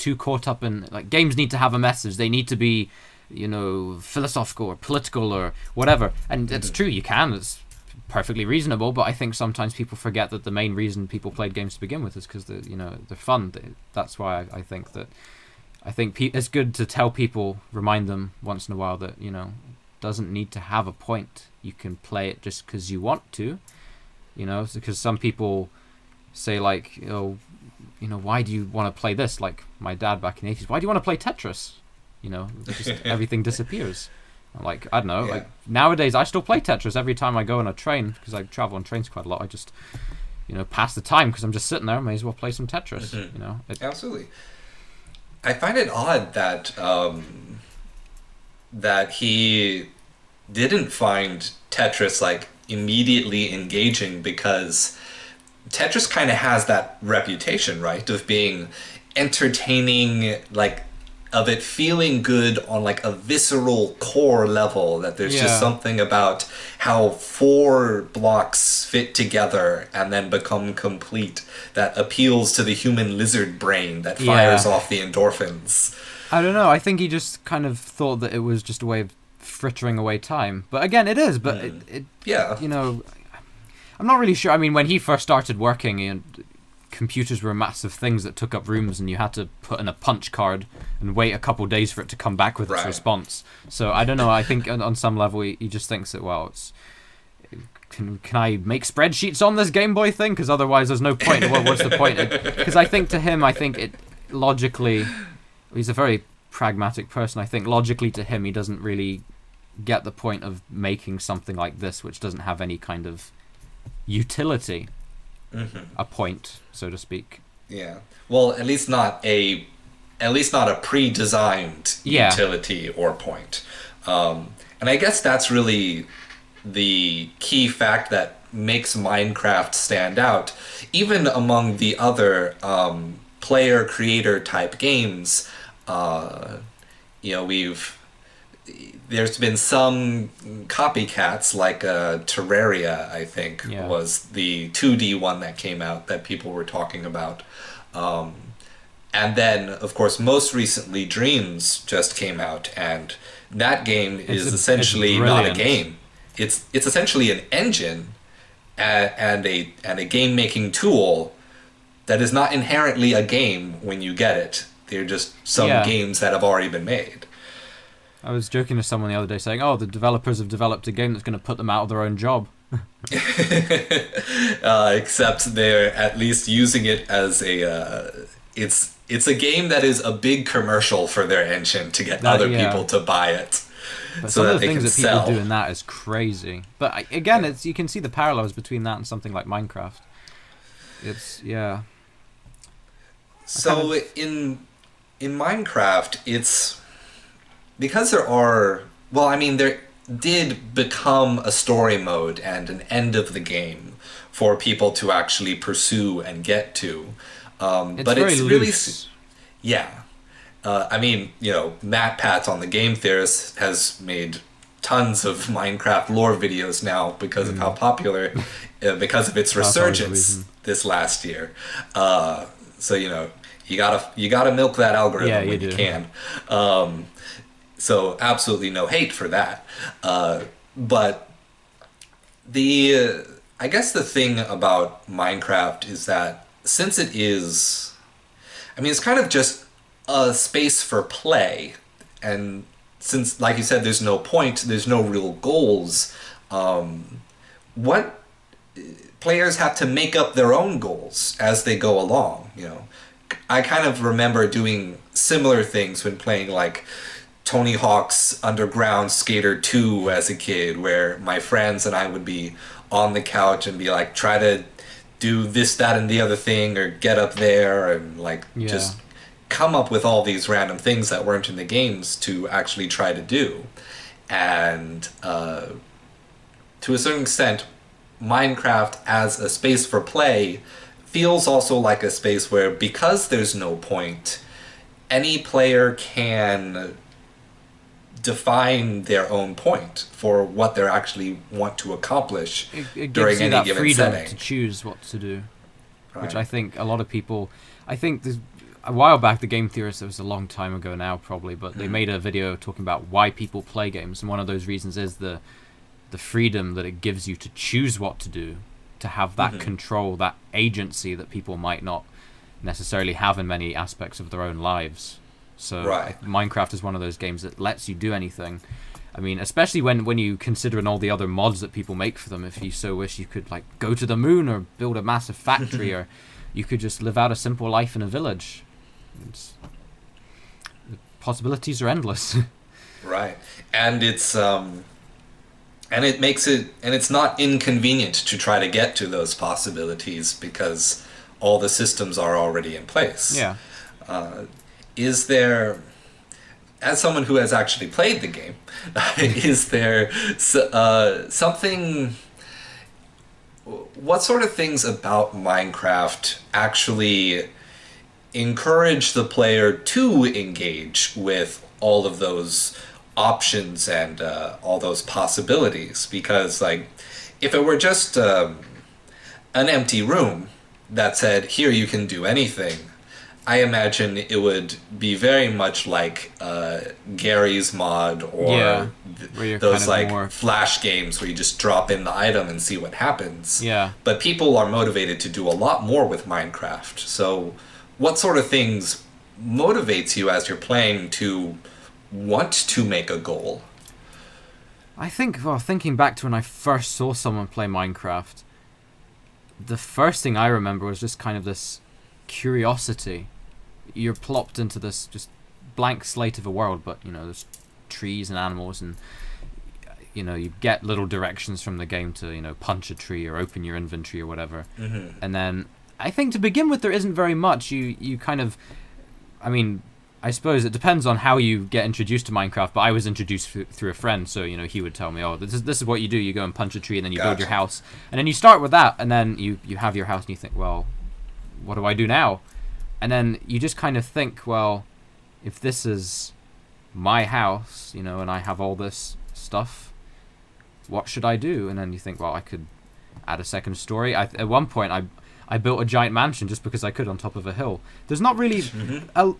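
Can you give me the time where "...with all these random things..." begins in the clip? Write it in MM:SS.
04:29.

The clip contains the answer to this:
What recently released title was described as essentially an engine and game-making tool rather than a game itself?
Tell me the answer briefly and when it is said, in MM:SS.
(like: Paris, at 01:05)
Dreams, at 02:31.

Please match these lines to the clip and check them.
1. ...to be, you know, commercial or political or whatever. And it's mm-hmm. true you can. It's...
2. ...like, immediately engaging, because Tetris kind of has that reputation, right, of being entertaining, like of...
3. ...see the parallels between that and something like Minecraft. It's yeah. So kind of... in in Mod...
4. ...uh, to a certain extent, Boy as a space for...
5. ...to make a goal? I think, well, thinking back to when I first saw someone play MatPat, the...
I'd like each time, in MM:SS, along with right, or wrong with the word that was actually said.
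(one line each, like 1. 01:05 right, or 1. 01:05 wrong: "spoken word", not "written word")
1. 00:02 wrong: "philosophical", not "commercial"
2. 00:52 right
3. 03:07 wrong: "Minecraft", not "Mod"
4. 04:35 wrong: "Minecraft", not "Boy"
5. 06:32 wrong: "Minecraft", not "MatPat".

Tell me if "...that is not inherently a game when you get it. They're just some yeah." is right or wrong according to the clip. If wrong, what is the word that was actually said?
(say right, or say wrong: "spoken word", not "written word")
right.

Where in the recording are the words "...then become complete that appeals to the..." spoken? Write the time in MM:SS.
01:10.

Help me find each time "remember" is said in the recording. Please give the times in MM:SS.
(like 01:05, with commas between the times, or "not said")
04:14, 06:40.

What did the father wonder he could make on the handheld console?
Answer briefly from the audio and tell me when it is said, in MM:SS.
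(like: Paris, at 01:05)
Spreadsheets, at 01:38.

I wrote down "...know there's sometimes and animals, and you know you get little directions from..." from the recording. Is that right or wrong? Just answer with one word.
wrong.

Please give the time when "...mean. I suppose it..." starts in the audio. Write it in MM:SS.
06:59.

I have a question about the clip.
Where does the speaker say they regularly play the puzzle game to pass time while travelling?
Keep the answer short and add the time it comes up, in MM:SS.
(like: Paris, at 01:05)
On a train, at 00:37.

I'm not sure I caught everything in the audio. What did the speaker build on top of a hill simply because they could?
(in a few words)
A giant mansion.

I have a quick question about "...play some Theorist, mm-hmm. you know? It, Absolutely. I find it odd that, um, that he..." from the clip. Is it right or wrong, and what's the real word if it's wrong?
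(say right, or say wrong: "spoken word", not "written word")
wrong: "Tetris", not "Theorist".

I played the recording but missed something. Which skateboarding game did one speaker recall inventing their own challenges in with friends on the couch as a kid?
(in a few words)
Tony Hawk's Underground Skater 2.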